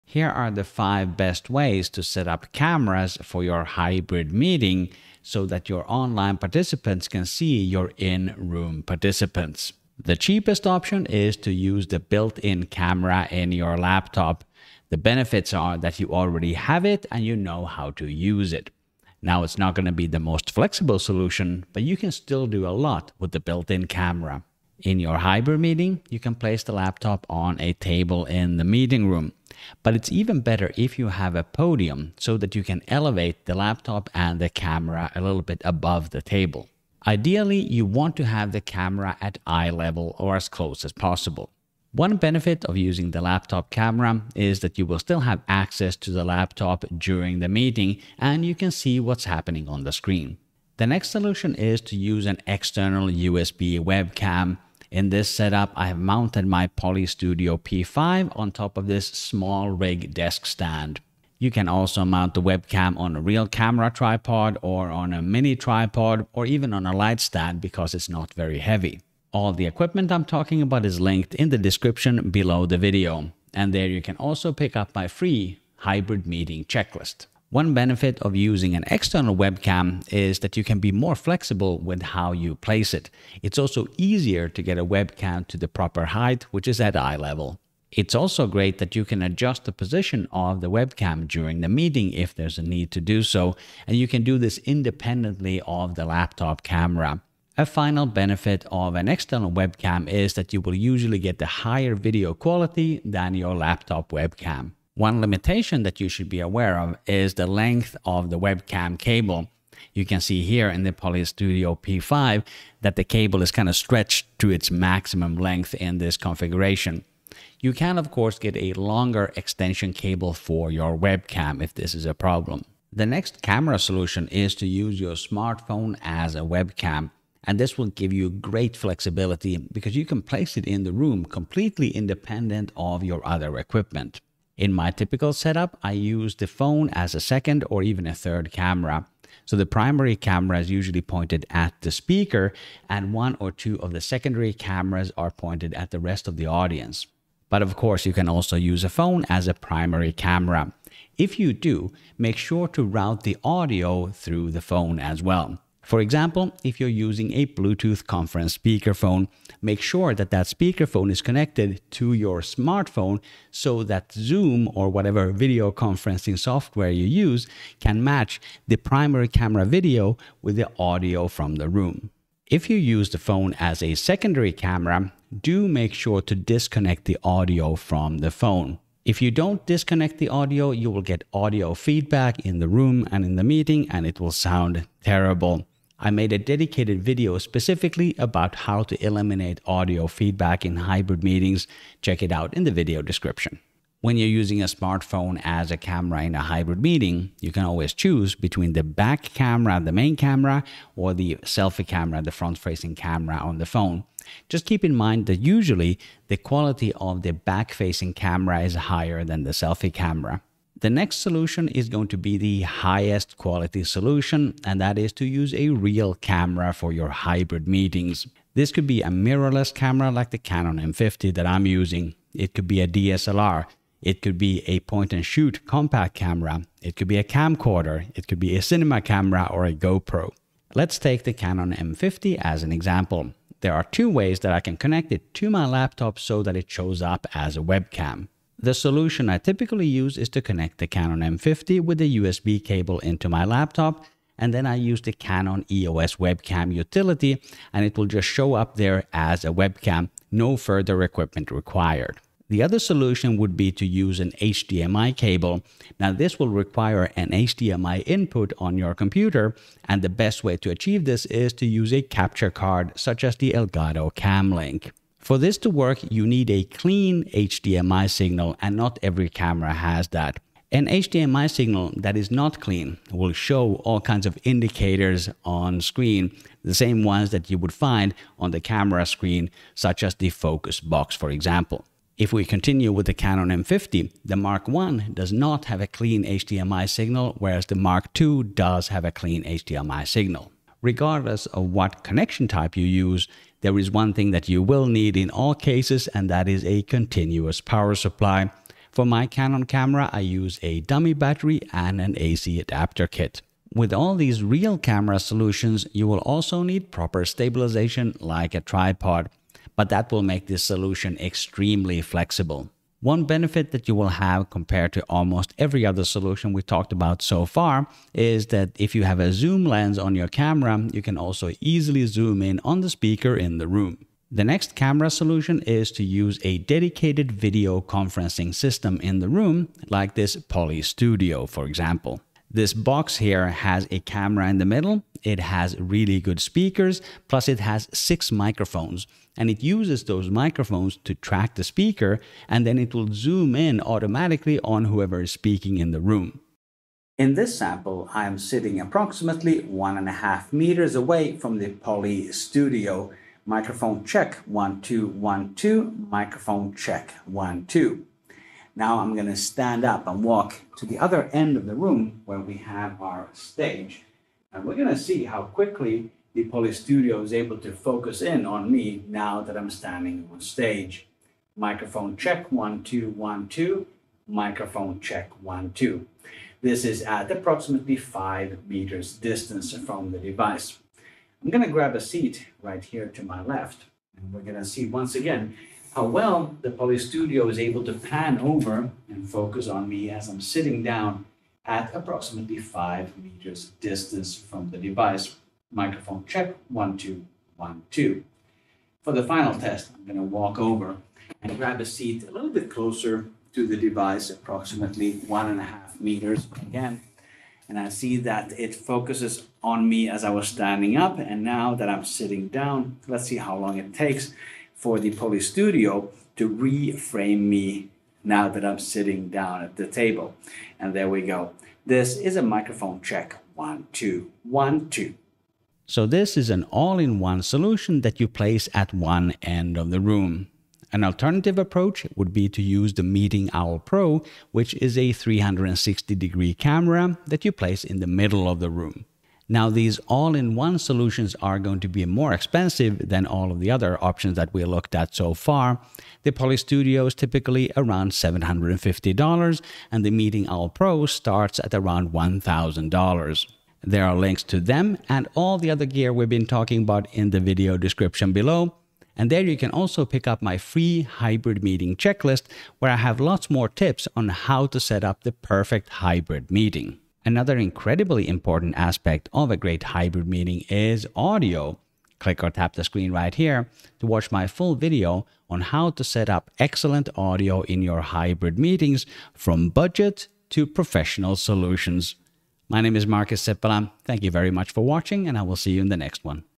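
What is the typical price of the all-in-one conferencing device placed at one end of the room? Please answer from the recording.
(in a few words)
$750.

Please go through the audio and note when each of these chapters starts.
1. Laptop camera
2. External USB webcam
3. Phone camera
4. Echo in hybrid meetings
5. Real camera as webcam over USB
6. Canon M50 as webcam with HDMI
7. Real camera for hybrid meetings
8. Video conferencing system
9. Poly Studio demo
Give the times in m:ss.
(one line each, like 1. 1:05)
1. 0:10
2. 0:51
3. 2:02
4. 2:52
5. 3:30
6. 4:12
7. 4:51
8. 5:24
9. 5:46.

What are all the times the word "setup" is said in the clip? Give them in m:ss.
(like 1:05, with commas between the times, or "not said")
0:55, 2:15.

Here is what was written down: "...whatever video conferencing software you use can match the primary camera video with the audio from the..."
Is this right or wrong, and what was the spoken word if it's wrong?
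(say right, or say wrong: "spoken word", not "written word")
right.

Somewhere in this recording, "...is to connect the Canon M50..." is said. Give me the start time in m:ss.
4:00.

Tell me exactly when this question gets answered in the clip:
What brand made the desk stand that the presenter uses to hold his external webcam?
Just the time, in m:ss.
0:59.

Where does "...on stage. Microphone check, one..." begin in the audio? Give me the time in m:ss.
6:10.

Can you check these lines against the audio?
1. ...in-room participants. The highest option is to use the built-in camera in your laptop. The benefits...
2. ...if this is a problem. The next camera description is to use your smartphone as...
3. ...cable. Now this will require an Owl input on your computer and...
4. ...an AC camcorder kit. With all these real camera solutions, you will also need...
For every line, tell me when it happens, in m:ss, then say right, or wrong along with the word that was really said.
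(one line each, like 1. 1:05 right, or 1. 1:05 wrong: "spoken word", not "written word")
1. 0:07 wrong: "cheapest", not "highest"
2. 2:01 wrong: "solution", not "description"
3. 4:15 wrong: "HDMI", not "Owl"
4. 5:02 wrong: "adapter", not "camcorder".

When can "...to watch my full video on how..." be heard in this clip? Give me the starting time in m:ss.
7:53.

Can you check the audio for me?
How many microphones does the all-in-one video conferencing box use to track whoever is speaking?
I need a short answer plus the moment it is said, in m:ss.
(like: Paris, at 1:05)
6, at 5:37.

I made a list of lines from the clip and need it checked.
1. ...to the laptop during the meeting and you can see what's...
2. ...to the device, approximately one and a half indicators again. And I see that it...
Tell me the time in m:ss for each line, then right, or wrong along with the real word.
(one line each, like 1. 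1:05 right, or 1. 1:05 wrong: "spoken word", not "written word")
1. 0:45 right
2. 6:43 wrong: "meters", not "indicators".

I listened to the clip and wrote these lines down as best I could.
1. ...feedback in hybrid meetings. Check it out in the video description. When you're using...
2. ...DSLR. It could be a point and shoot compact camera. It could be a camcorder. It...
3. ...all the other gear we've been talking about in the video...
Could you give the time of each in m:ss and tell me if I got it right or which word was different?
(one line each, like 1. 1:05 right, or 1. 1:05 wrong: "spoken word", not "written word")
1. 3:10 right
2. 3:42 right
3. 7:35 right.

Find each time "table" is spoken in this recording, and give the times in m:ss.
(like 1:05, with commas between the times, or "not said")
0:27, 0:36, 6:59.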